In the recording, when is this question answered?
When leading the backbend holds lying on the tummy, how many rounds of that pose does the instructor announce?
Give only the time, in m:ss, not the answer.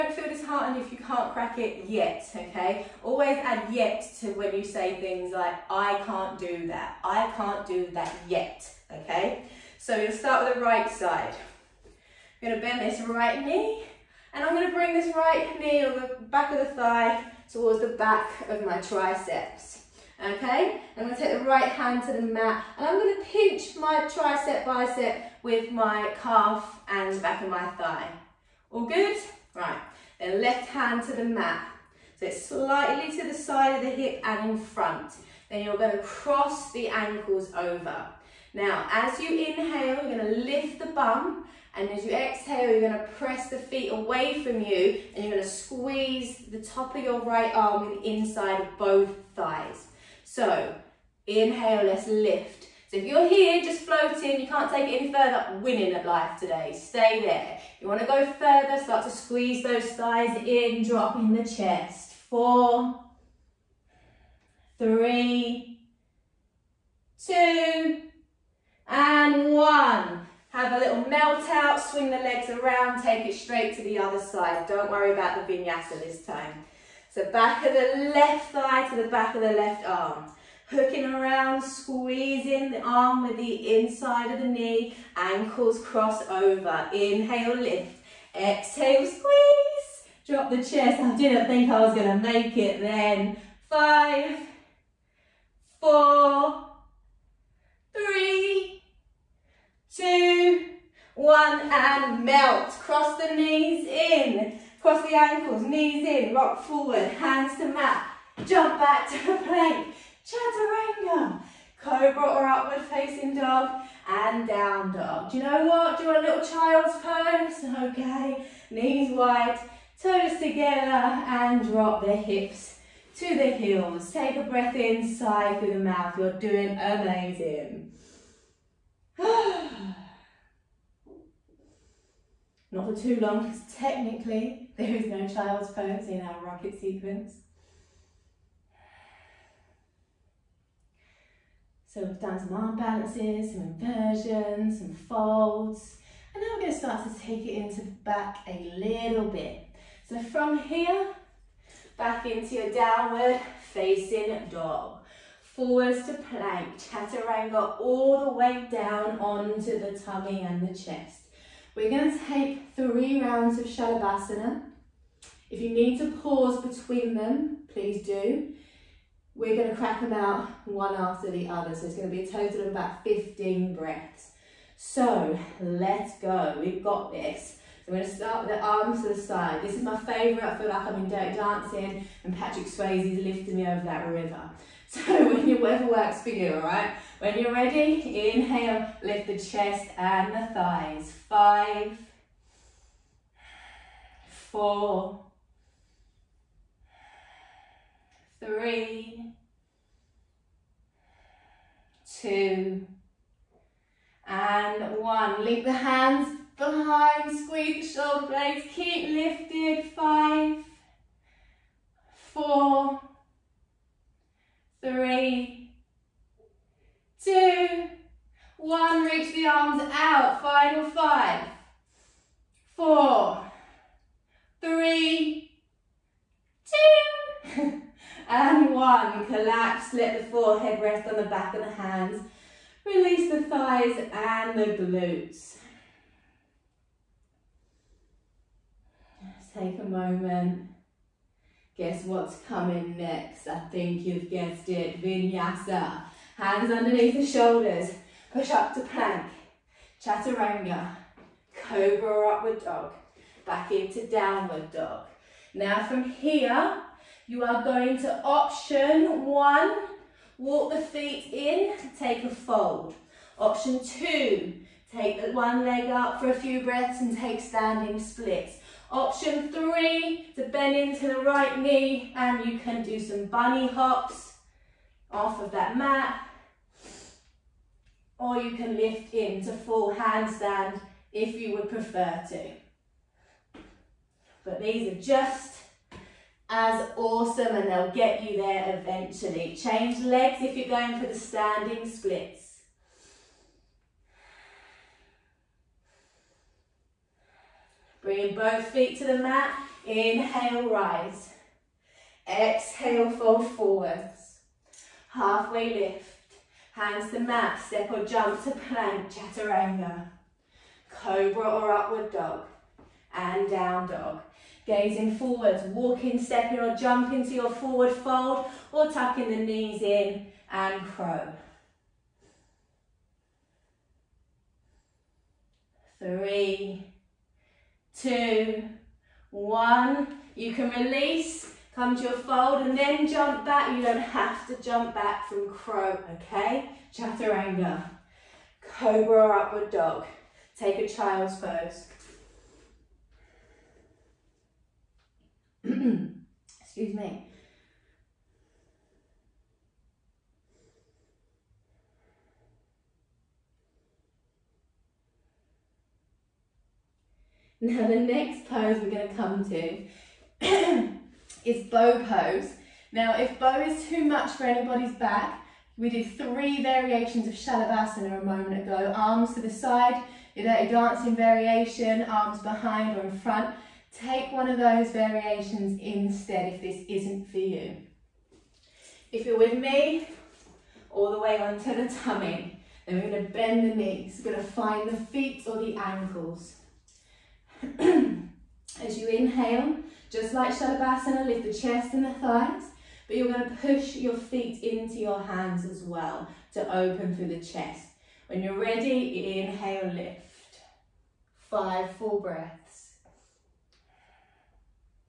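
2:42.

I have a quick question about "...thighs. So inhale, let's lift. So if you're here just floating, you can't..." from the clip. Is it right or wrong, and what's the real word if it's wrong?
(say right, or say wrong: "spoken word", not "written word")
right.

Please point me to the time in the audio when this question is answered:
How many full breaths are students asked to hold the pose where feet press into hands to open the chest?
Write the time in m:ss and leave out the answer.
6:41.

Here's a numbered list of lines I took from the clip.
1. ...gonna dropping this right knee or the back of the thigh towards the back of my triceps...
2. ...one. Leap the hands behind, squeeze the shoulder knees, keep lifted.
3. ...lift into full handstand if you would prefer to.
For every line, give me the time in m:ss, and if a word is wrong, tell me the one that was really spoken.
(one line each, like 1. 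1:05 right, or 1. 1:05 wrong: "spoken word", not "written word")
1. 0:14 wrong: "bring", not "dropping"
2. 3:24 wrong: "blades", not "knees"
3. 4:38 right.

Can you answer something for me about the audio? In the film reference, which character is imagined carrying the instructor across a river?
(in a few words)
Patrick.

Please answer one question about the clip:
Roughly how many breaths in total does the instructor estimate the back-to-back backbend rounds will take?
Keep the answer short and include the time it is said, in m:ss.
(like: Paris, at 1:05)
15, at 2:52.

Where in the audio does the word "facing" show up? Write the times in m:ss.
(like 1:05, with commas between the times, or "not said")
1:52, 2:33.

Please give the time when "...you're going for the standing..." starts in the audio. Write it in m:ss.
4:50.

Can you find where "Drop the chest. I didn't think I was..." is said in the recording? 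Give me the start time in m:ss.
1:30.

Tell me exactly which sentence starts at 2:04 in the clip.
Take a breath in, sigh through the mouth.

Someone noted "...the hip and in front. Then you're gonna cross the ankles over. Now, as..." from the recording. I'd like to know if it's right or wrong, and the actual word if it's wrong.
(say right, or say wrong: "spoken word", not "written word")
right.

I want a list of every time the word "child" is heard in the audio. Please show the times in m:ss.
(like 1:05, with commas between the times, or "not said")
1:56, 2:15, 5:40.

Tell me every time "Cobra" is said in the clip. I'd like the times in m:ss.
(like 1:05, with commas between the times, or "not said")
1:51, 4:11, 5:10, 5:38.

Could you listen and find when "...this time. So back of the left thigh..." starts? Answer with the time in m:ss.
1:16.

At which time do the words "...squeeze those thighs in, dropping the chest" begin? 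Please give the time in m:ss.
0:59.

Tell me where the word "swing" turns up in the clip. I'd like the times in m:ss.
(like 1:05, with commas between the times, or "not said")
1:11.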